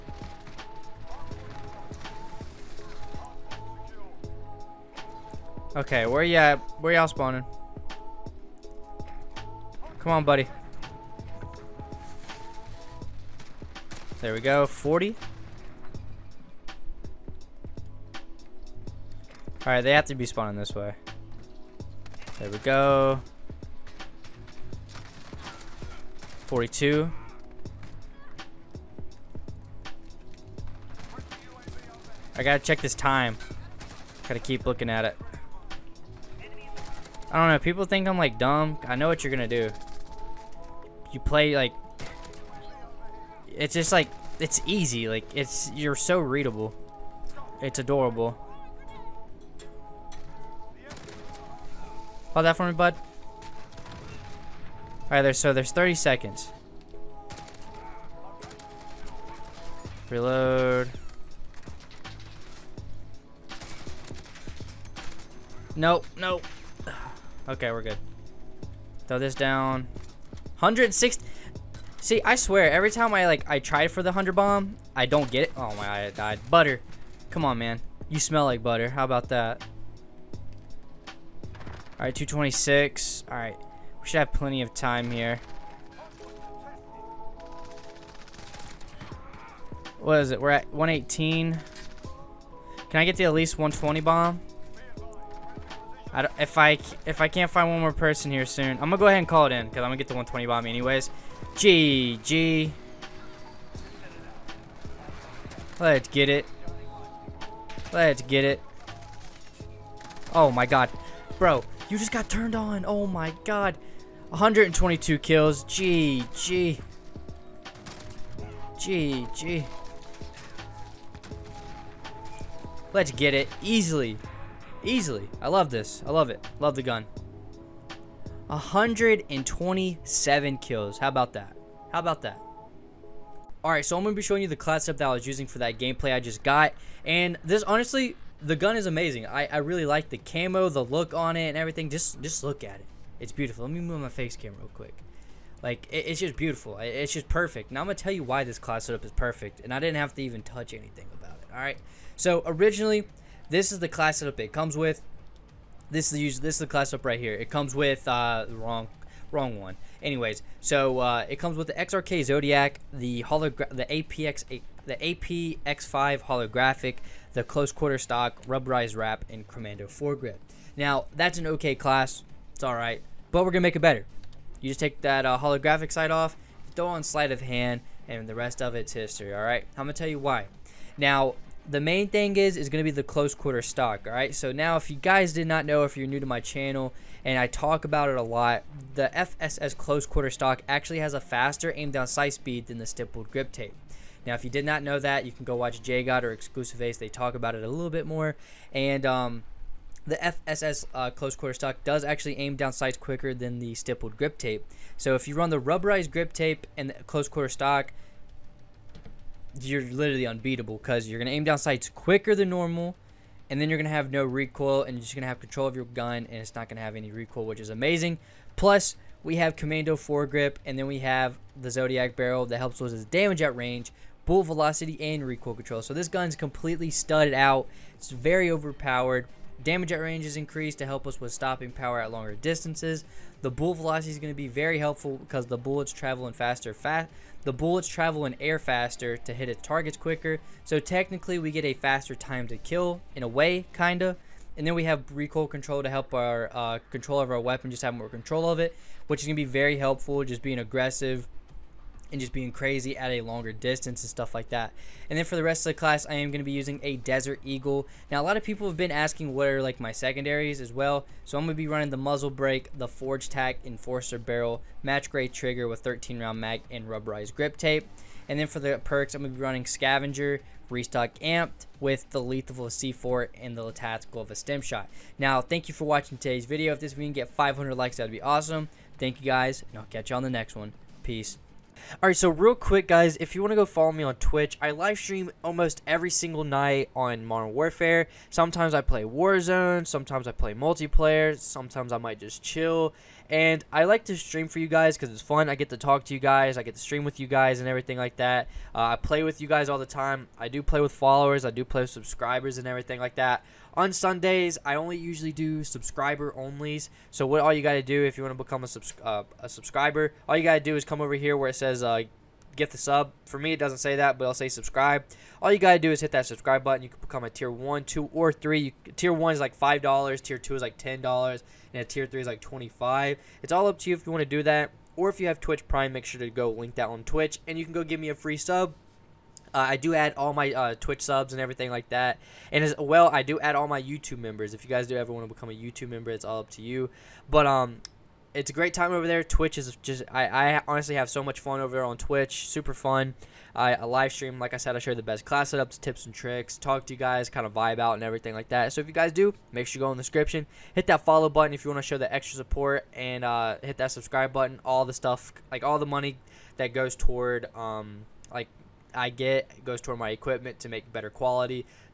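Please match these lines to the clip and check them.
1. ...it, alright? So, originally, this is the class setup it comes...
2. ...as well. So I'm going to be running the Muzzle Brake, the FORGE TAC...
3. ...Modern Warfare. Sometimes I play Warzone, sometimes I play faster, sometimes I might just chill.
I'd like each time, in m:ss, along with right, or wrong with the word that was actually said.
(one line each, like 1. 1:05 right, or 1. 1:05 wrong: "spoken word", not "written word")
1. 2:31 right
2. 4:20 right
3. 4:47 wrong: "multiplayer", not "faster".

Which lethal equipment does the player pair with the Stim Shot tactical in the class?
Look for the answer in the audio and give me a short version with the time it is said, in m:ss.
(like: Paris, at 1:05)
C4, at 4:32.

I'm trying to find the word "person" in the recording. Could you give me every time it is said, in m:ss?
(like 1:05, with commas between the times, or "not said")
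1:37.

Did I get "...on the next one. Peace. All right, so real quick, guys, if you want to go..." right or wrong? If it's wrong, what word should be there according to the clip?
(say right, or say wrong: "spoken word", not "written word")
right.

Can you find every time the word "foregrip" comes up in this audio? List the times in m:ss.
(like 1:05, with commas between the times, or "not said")
2:49, 3:39.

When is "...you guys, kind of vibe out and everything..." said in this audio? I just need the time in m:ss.
5:46.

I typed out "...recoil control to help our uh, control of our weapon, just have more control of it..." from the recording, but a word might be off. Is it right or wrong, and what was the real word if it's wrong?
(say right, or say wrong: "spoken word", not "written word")
right.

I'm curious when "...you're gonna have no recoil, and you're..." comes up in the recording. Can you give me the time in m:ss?
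3:33.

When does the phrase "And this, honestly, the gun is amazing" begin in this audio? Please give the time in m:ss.
2:17.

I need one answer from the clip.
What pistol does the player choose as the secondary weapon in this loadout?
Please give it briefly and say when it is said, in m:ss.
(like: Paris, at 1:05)
Desert Eagle, at 4:16.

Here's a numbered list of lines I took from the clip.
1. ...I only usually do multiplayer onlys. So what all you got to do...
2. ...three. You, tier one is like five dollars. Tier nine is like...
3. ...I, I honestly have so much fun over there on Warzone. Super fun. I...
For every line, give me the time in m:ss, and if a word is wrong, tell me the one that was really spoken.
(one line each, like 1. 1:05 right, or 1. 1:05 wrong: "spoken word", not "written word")
1. 5:04 wrong: "subscriber", not "multiplayer"
2. 5:18 wrong: "two", not "nine"
3. 5:40 wrong: "Twitch", not "Warzone".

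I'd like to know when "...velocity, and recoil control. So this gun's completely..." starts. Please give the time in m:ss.
3:44.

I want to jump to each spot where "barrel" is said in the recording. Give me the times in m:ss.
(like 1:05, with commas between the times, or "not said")
3:42, 4:24.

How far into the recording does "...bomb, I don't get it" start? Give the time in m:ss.
1:14.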